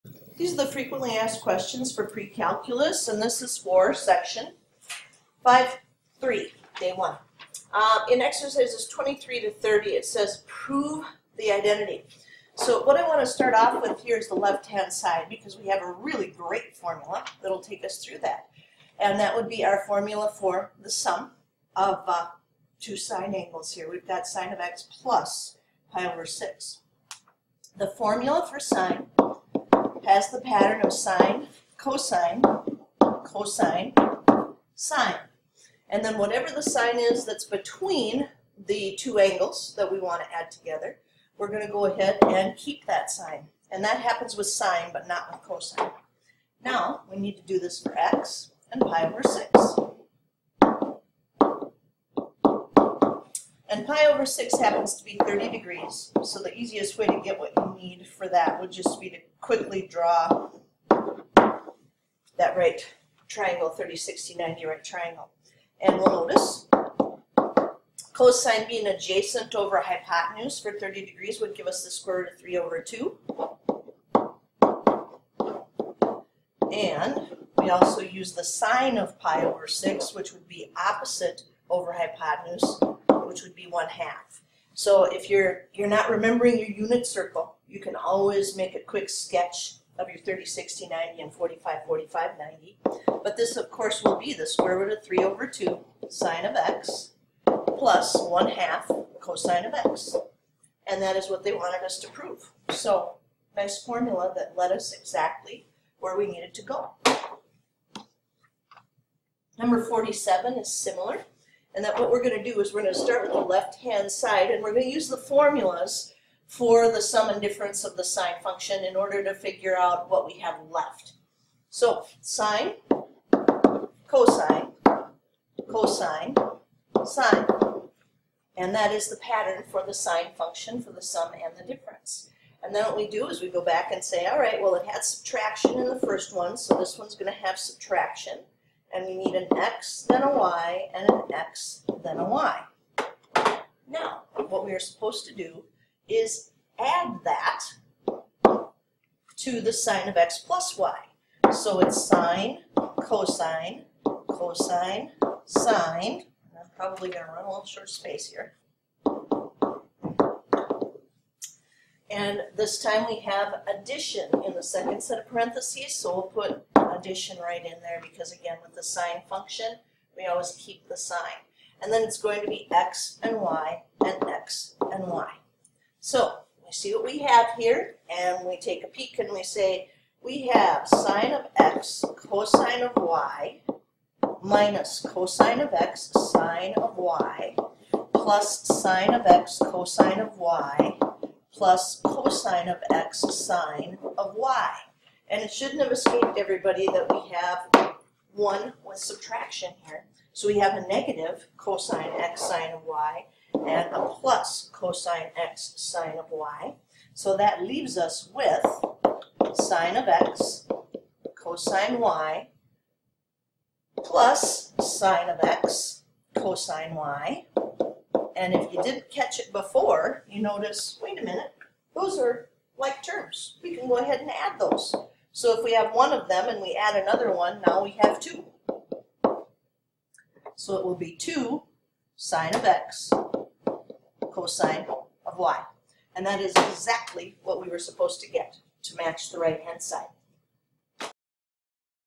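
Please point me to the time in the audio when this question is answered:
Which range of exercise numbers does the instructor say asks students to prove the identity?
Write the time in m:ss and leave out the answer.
0:08.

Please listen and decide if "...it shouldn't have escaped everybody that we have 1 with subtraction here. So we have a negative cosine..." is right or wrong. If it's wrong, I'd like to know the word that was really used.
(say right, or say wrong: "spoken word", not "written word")
right.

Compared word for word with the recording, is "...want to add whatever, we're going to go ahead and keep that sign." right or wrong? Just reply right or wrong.
wrong.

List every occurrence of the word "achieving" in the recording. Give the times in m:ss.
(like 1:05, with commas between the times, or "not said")
not said.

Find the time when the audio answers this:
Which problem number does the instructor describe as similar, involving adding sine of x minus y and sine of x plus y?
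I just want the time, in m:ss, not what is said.
1:49.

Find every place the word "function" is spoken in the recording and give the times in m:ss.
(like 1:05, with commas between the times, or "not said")
1:58, 2:10, 2:49.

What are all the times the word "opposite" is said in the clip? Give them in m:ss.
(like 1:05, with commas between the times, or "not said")
1:20.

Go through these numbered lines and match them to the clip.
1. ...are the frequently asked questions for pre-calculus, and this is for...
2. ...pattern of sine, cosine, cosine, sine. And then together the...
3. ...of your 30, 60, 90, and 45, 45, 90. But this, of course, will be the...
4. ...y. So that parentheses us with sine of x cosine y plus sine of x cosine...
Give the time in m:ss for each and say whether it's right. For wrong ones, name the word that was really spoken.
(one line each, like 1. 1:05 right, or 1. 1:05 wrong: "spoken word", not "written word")
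1. 0:00 right
2. 0:30 wrong: "whatever", not "together"
3. 1:29 right
4. 3:26 wrong: "leaves", not "parentheses".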